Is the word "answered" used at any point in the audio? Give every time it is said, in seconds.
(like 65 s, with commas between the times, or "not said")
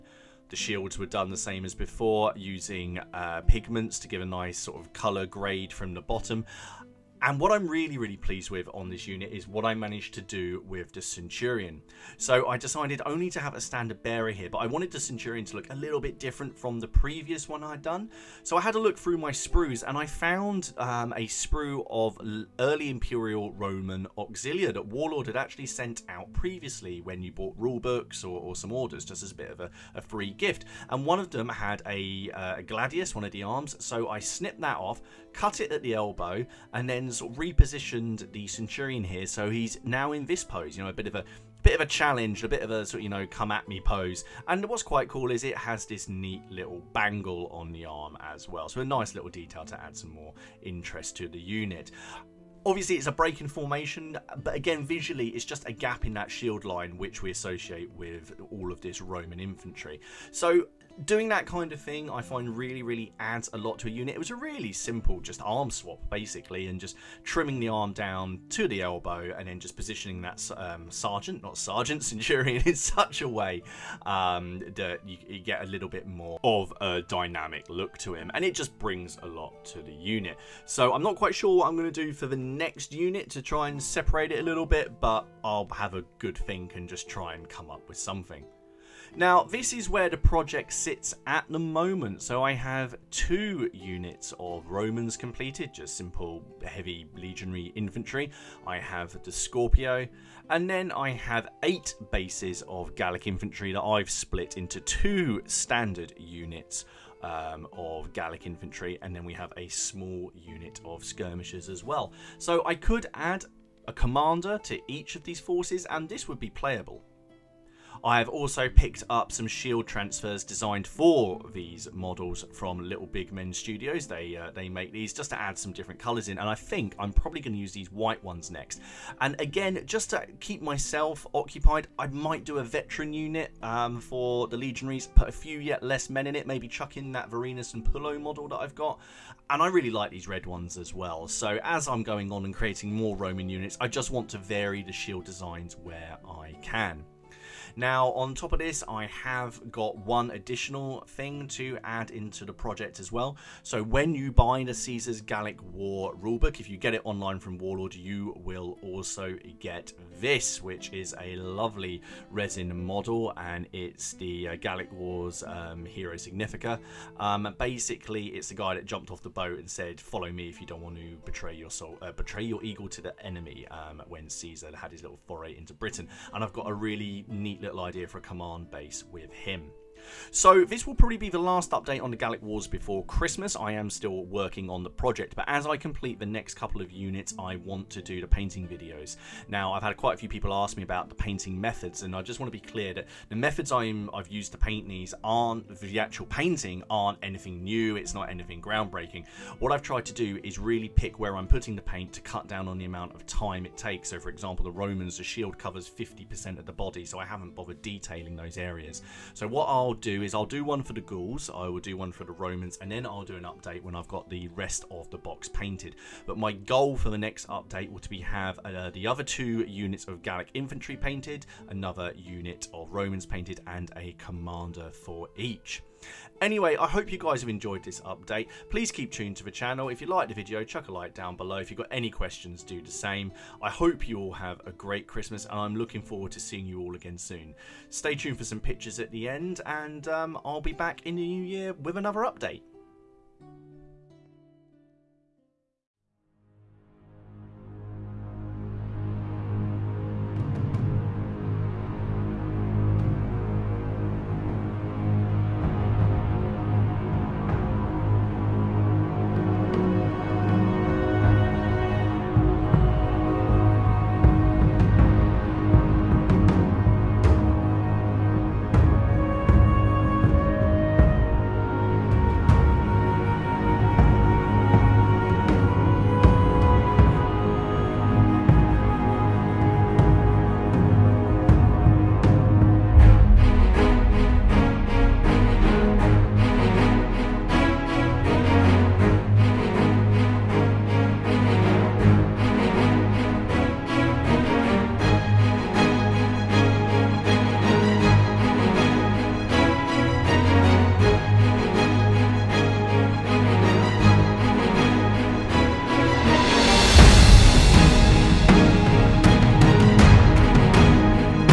not said.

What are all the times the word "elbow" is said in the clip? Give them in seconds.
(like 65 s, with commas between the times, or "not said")
35 s, 68 s.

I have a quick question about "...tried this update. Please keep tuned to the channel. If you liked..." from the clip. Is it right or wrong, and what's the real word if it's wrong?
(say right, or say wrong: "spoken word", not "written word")
wrong: "enjoyed", not "tried".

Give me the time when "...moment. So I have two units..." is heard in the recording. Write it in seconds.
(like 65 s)
91 s.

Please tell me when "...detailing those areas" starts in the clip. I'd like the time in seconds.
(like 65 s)
207 s.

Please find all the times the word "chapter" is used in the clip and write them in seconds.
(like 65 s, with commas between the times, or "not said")
not said.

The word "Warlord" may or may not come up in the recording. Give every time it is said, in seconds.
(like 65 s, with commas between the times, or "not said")
24 s, 157 s.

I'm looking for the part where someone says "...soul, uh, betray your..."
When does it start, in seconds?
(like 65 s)
171 s.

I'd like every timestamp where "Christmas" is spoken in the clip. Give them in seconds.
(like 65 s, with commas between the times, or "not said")
183 s, 235 s.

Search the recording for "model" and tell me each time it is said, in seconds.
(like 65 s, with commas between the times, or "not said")
121 s, 138 s, 162 s.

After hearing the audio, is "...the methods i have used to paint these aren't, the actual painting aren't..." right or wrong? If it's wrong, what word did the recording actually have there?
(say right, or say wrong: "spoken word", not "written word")
right.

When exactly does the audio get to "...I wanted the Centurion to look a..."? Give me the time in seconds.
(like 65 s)
14 s.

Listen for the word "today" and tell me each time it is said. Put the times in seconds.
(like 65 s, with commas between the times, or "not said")
not said.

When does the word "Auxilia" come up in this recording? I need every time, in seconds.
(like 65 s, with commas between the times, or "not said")
24 s.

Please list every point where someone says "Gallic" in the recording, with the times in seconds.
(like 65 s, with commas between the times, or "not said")
102 s, 108 s, 155 s, 164 s, 182 s, 220 s.